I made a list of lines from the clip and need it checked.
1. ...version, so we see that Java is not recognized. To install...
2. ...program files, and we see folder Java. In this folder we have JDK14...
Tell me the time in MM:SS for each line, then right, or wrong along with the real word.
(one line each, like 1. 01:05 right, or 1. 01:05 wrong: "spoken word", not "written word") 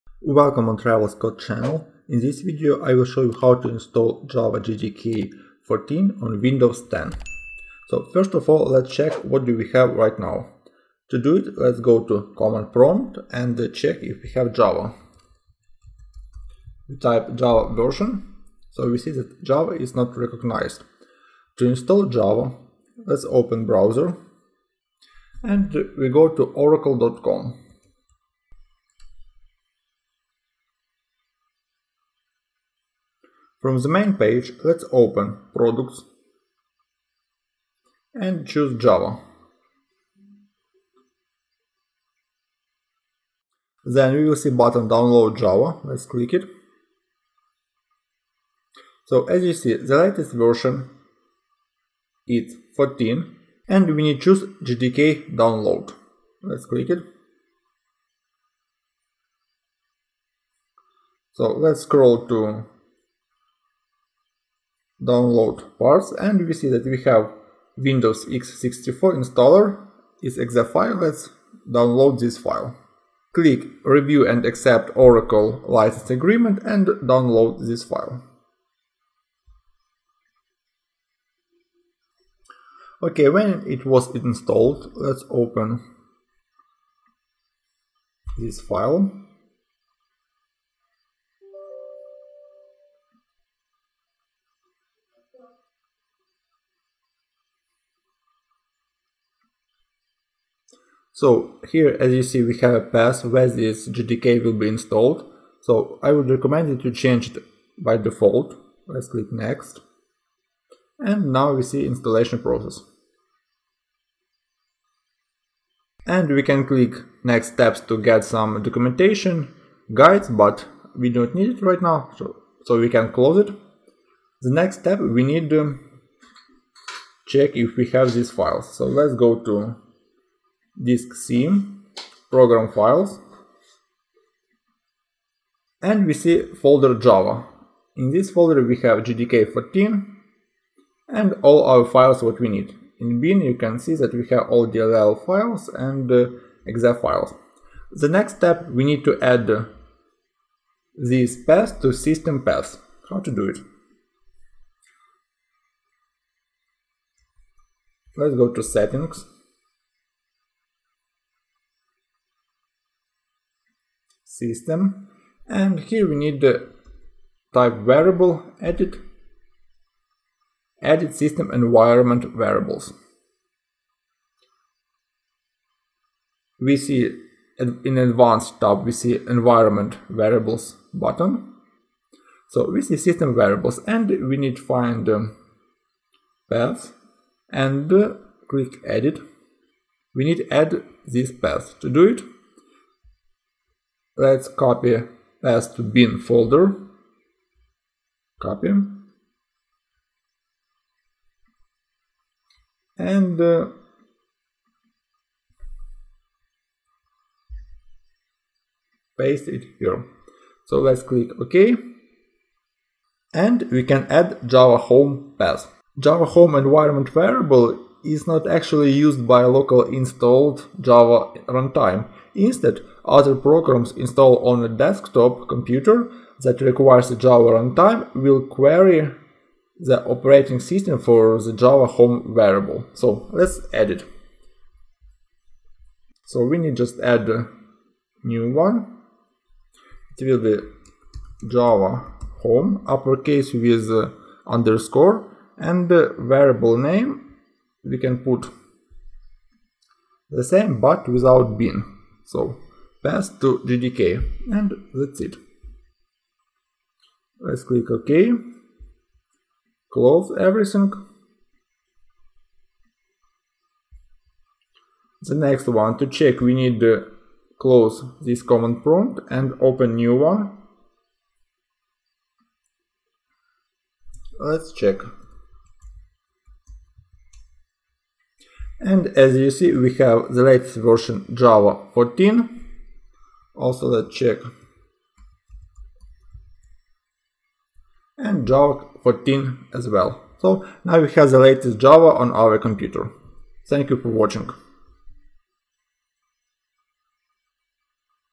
1. 00:17 right
2. 02:12 right.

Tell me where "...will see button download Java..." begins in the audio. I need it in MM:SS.
00:44.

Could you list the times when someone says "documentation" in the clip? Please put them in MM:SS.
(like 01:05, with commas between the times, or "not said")
01:58.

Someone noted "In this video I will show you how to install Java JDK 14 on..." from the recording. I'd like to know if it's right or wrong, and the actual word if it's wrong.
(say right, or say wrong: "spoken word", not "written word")
right.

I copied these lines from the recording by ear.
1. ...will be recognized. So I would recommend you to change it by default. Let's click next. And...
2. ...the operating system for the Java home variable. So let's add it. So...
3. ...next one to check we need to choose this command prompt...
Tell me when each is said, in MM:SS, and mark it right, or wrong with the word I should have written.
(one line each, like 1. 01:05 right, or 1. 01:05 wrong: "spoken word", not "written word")
1. 01:44 wrong: "installed", not "recognized"
2. 03:49 right
3. 04:25 wrong: "close", not "choose".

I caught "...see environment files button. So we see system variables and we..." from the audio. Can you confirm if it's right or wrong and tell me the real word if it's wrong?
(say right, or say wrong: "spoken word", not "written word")
wrong: "variables", not "files".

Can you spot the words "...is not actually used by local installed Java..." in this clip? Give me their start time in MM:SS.
03:38.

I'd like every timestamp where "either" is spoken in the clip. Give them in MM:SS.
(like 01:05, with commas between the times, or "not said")
not said.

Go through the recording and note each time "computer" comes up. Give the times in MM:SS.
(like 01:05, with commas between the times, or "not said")
03:45, 04:52.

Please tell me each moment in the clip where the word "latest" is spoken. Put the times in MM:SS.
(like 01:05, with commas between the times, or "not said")
00:49, 04:40, 04:51.